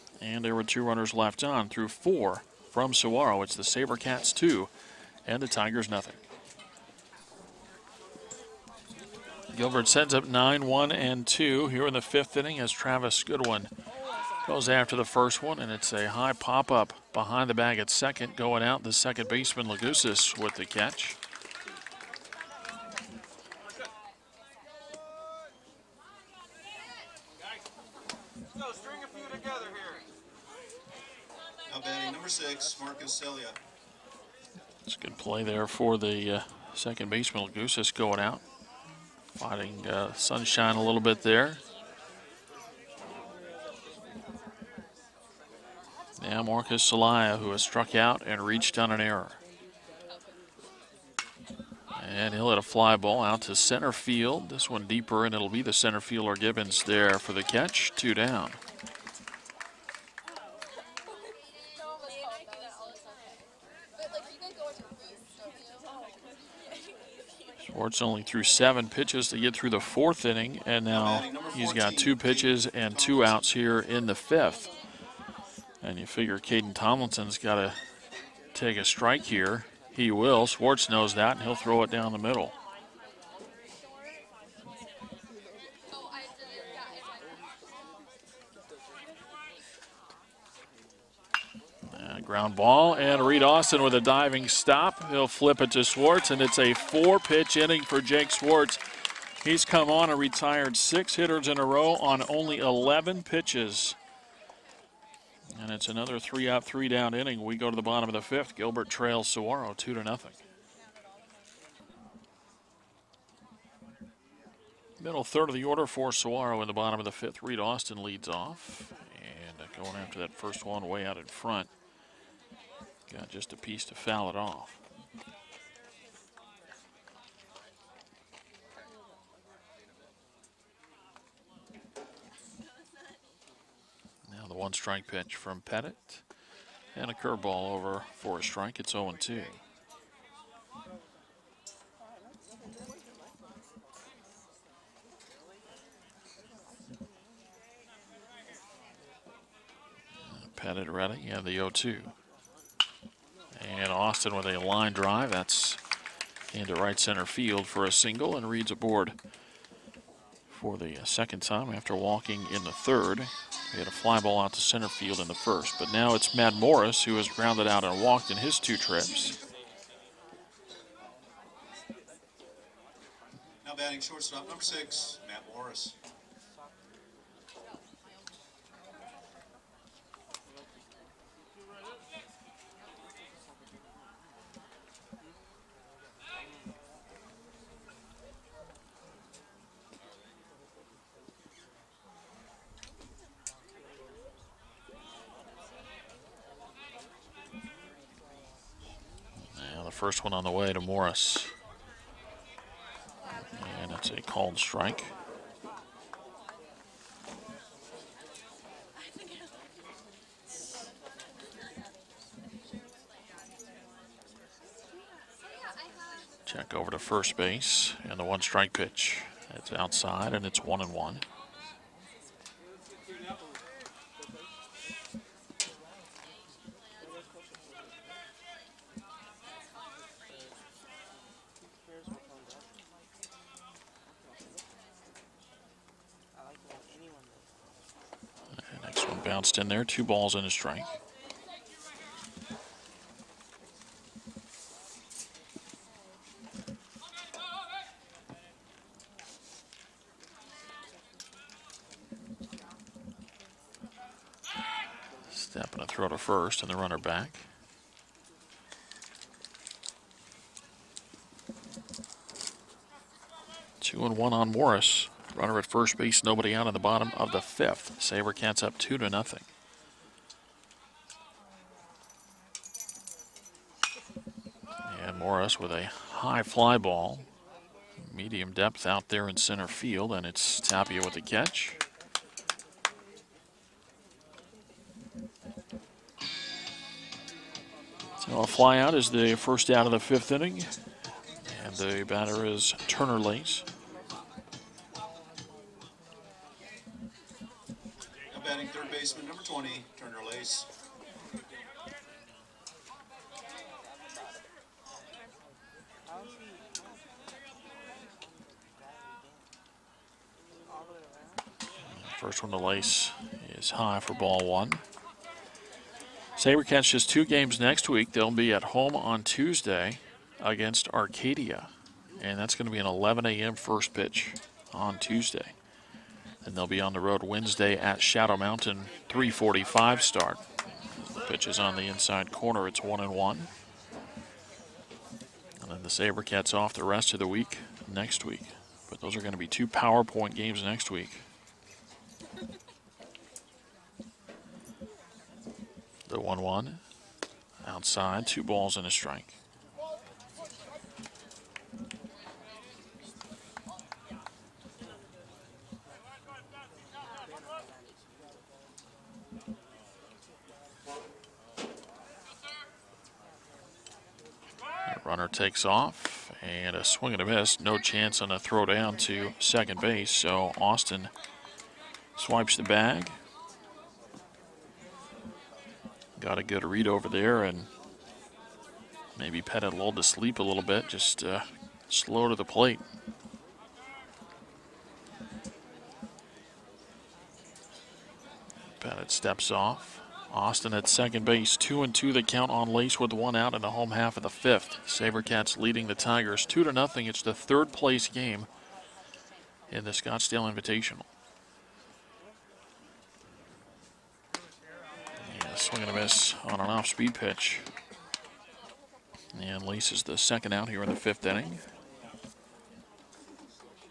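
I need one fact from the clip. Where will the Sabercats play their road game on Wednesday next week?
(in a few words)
Shadow Mountain.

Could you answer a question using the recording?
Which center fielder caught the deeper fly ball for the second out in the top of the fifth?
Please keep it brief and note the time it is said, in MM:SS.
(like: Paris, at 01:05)
Gibbons, at 00:56.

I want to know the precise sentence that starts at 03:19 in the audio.
first one on the way to Morris.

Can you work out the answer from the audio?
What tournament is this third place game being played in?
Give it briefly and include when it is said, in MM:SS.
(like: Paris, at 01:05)
Scottsdale Invitational, at 06:39.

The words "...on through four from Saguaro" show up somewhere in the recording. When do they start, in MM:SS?
00:01.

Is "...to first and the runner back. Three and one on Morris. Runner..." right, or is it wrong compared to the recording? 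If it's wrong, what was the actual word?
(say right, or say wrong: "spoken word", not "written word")
wrong: "Two", not "Three".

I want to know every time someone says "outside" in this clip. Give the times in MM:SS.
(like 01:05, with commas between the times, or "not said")
03:39, 05:47.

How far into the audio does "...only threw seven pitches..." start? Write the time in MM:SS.
01:08.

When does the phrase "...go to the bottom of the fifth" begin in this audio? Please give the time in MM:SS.
01:47.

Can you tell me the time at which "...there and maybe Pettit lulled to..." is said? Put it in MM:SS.
06:17.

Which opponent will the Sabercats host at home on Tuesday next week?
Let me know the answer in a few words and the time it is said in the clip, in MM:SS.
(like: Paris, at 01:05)
Arcadia, at 05:20.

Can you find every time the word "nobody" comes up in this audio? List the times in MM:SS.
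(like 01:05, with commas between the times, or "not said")
04:26.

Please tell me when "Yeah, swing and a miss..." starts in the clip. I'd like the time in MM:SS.
06:44.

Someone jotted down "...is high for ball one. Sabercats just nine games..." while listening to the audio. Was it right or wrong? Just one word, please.
wrong.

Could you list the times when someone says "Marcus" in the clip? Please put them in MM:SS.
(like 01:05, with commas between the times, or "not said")
00:32, 00:46.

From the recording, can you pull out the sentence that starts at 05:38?
But those are going to be two PowerPoint games next week.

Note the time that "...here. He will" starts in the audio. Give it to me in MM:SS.
01:19.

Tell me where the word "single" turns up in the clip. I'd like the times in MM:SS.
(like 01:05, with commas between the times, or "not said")
02:37.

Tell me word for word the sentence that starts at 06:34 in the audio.
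SaberCats leading the Tigers two to nothing.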